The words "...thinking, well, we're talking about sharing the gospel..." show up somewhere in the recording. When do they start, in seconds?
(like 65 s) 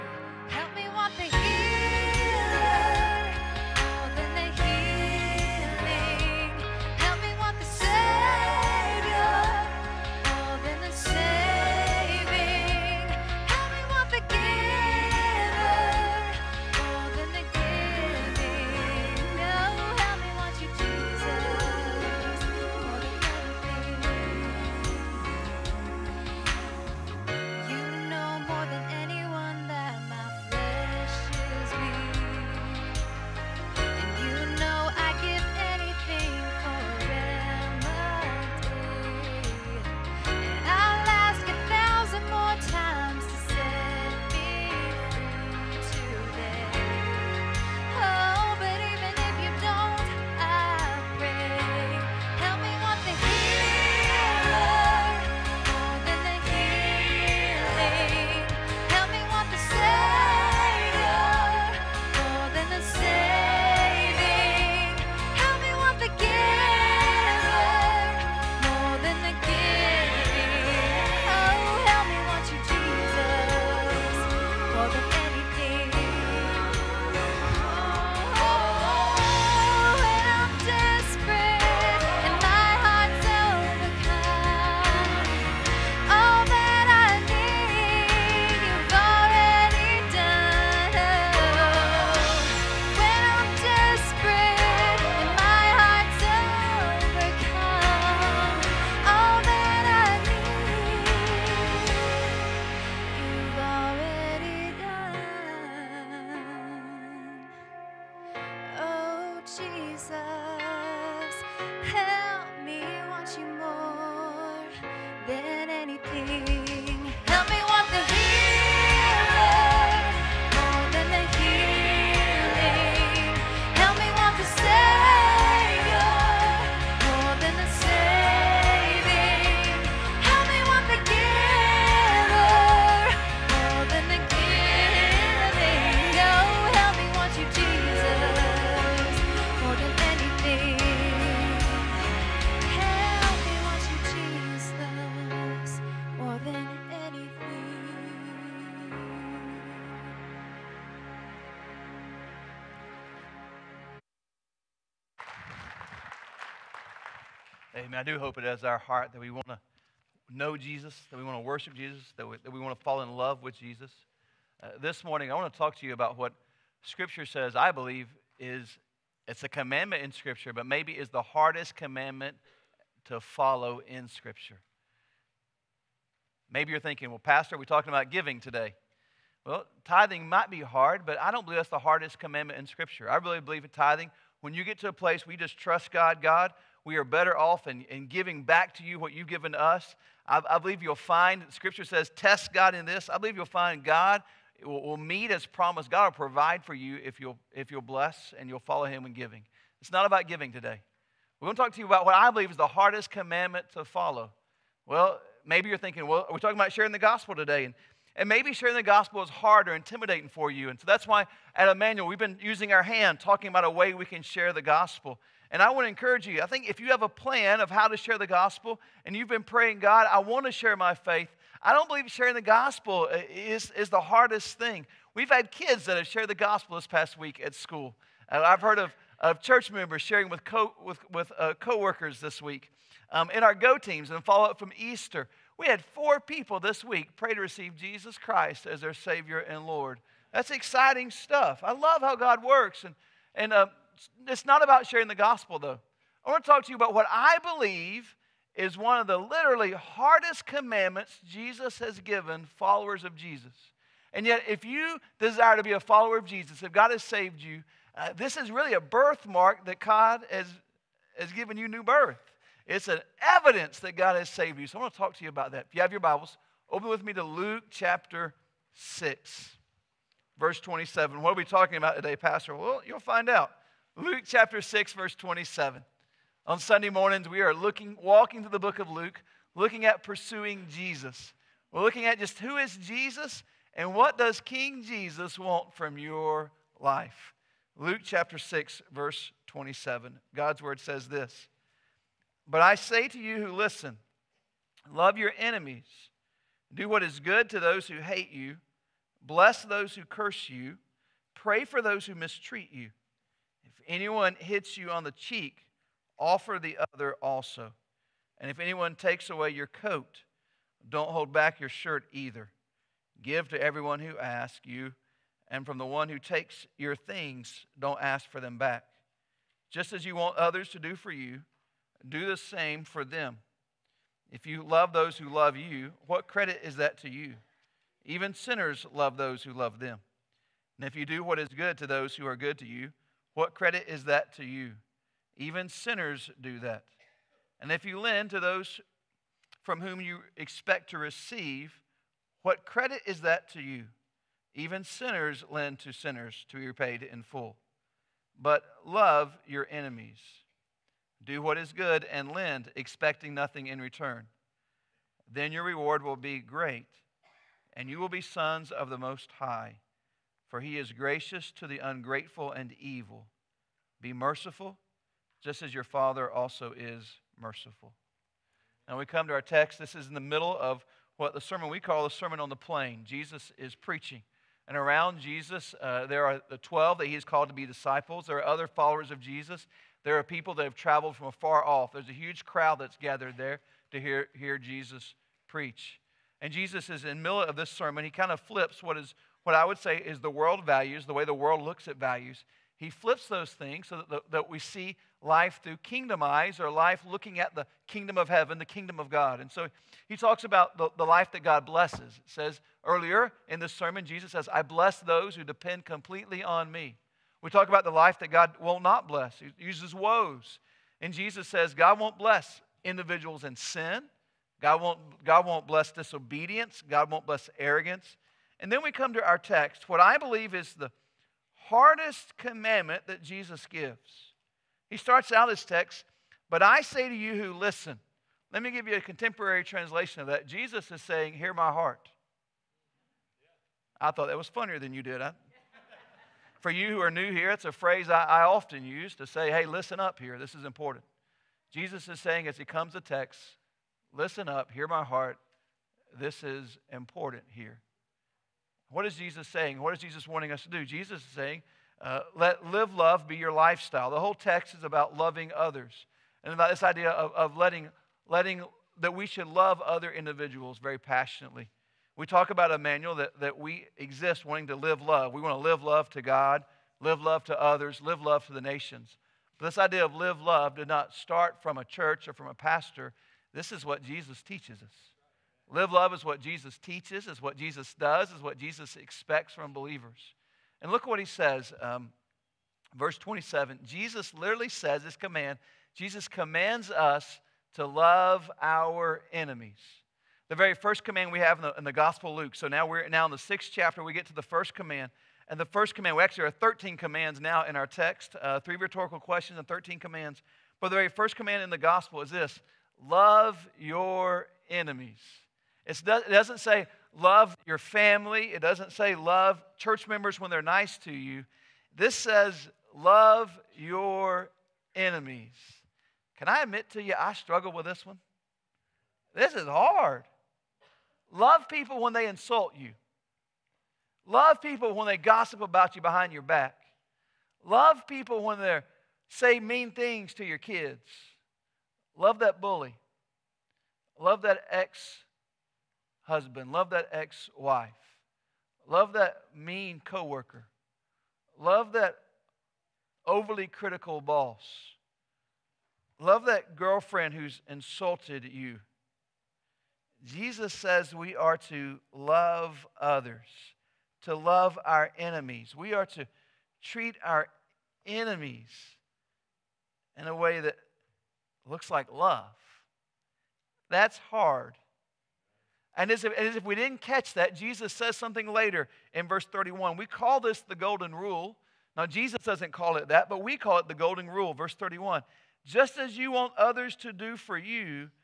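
205 s.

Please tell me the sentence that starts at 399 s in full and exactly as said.
And so he talks about the, the life that God blesses.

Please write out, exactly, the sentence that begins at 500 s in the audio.
But the very first command in the gospel is this love your enemies.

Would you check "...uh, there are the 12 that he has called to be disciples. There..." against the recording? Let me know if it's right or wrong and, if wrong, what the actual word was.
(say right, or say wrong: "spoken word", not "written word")
right.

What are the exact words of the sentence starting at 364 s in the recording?
Be merciful, just as your Father also is merciful.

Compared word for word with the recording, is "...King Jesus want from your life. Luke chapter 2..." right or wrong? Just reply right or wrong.
wrong.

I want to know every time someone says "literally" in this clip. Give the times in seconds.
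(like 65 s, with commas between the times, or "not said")
249 s, 484 s.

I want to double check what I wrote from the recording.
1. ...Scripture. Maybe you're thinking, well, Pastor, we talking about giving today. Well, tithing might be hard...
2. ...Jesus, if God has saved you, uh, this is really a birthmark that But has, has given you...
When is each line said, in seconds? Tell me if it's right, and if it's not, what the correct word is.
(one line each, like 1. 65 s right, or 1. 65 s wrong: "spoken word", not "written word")
1. 174 s right
2. 256 s wrong: "God", not "But".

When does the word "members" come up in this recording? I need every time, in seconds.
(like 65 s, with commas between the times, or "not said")
229 s, 510 s.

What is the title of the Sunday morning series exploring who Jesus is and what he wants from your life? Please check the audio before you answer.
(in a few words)
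Pursuing Jesus.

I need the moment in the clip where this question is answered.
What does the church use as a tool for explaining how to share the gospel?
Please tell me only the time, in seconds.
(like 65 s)
212 s.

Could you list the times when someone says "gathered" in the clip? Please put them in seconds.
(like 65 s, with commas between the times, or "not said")
382 s.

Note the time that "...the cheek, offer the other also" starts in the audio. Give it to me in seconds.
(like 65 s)
305 s.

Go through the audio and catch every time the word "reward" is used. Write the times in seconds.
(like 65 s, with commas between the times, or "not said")
355 s.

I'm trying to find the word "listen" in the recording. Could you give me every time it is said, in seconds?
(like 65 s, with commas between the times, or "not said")
293 s, 427 s, 439 s, 444 s.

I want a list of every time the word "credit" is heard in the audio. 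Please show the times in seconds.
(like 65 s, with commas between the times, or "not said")
326 s, 333 s, 342 s.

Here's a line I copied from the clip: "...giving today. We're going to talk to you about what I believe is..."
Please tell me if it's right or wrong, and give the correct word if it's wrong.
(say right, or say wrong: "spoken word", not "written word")
right.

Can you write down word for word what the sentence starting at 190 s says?
I, I, believe you'll find, Scripture says, test God in this.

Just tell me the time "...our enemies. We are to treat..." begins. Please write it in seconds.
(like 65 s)
554 s.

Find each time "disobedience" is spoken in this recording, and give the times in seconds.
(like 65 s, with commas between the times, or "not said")
415 s.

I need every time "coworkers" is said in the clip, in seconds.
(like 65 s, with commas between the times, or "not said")
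231 s, 540 s.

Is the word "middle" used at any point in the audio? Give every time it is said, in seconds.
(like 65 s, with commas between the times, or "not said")
370 s, 387 s.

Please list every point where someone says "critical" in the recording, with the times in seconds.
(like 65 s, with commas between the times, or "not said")
543 s.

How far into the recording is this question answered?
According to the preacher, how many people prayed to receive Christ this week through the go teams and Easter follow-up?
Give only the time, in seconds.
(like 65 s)
235 s.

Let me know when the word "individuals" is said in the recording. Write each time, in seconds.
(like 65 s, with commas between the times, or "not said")
412 s, 460 s.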